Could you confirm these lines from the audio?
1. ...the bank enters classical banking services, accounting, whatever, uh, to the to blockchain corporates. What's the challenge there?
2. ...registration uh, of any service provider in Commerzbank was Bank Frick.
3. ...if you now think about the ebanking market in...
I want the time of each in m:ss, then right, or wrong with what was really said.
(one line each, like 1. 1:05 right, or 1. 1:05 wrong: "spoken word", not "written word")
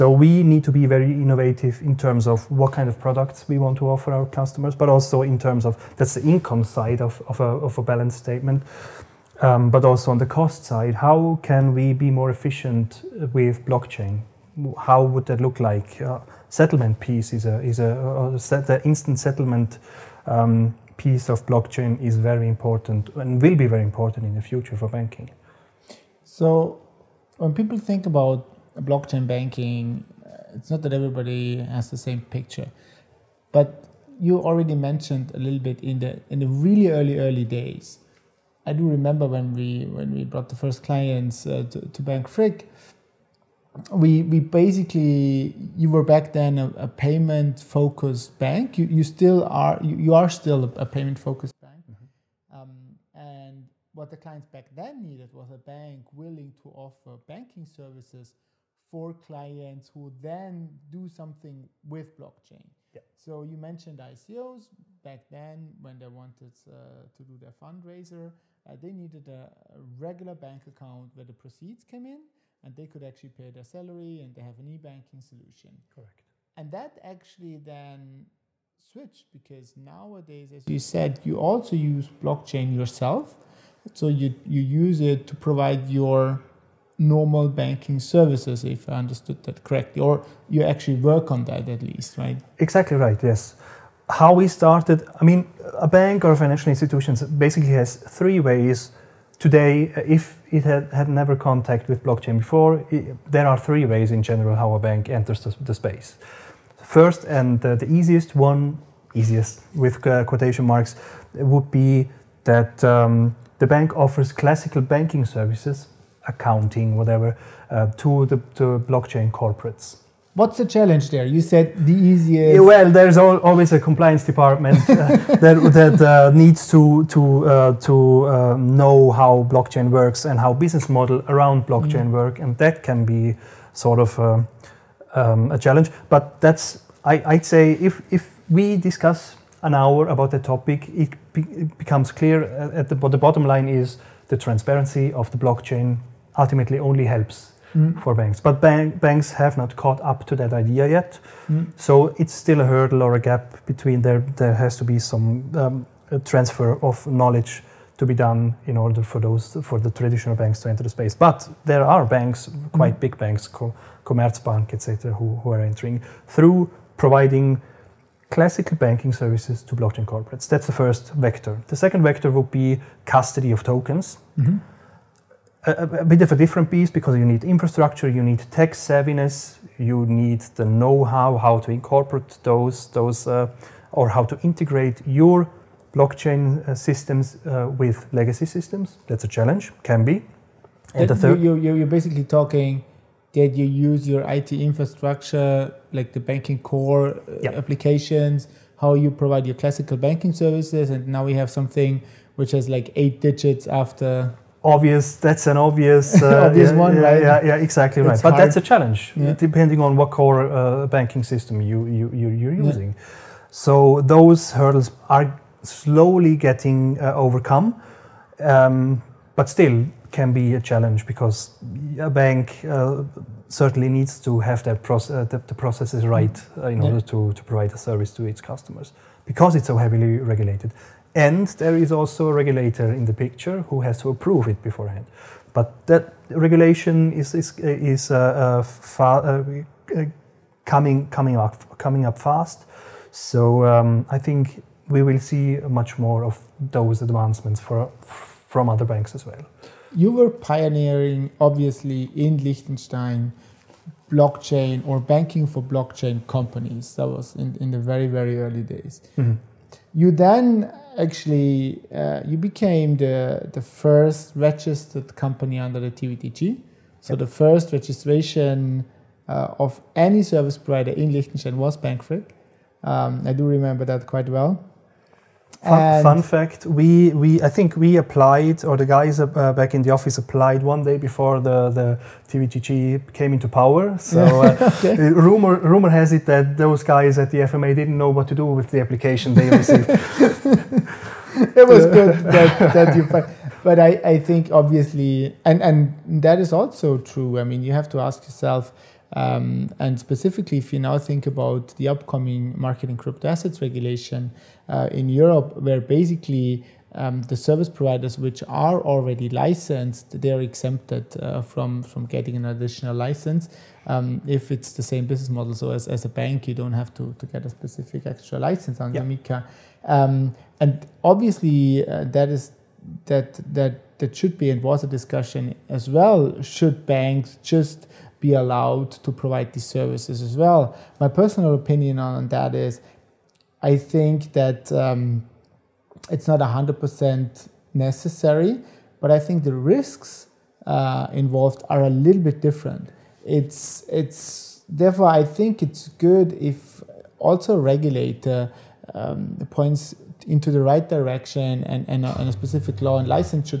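1. 1:53 wrong: "offers", not "enters"
2. 4:27 wrong: "Liechtenstein", not "Commerzbank"
3. 5:00 wrong: "upcoming", not "ebanking".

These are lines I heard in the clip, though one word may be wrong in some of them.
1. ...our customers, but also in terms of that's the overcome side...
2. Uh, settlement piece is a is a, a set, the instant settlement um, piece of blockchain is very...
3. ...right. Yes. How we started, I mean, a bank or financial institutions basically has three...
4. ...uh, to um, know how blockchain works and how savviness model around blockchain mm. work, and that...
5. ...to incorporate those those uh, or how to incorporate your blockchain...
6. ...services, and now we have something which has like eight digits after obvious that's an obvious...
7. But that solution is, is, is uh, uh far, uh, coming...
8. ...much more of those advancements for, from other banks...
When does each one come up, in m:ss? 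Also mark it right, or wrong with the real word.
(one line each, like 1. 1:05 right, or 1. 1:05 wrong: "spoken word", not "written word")
1. 0:04 wrong: "income", not "overcome"
2. 0:16 right
3. 1:32 right
4. 2:07 wrong: "business", not "savviness"
5. 3:01 wrong: "integrate", not "incorporate"
6. 3:20 right
7. 3:55 wrong: "regulation", not "solution"
8. 4:05 right.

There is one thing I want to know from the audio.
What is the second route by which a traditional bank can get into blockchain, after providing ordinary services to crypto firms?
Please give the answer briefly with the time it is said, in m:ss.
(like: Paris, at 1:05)
Custody of tokens, at 2:53.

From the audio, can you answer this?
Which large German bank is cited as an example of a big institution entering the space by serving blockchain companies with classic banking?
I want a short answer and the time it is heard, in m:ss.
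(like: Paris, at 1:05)
Commerzbank, at 2:44.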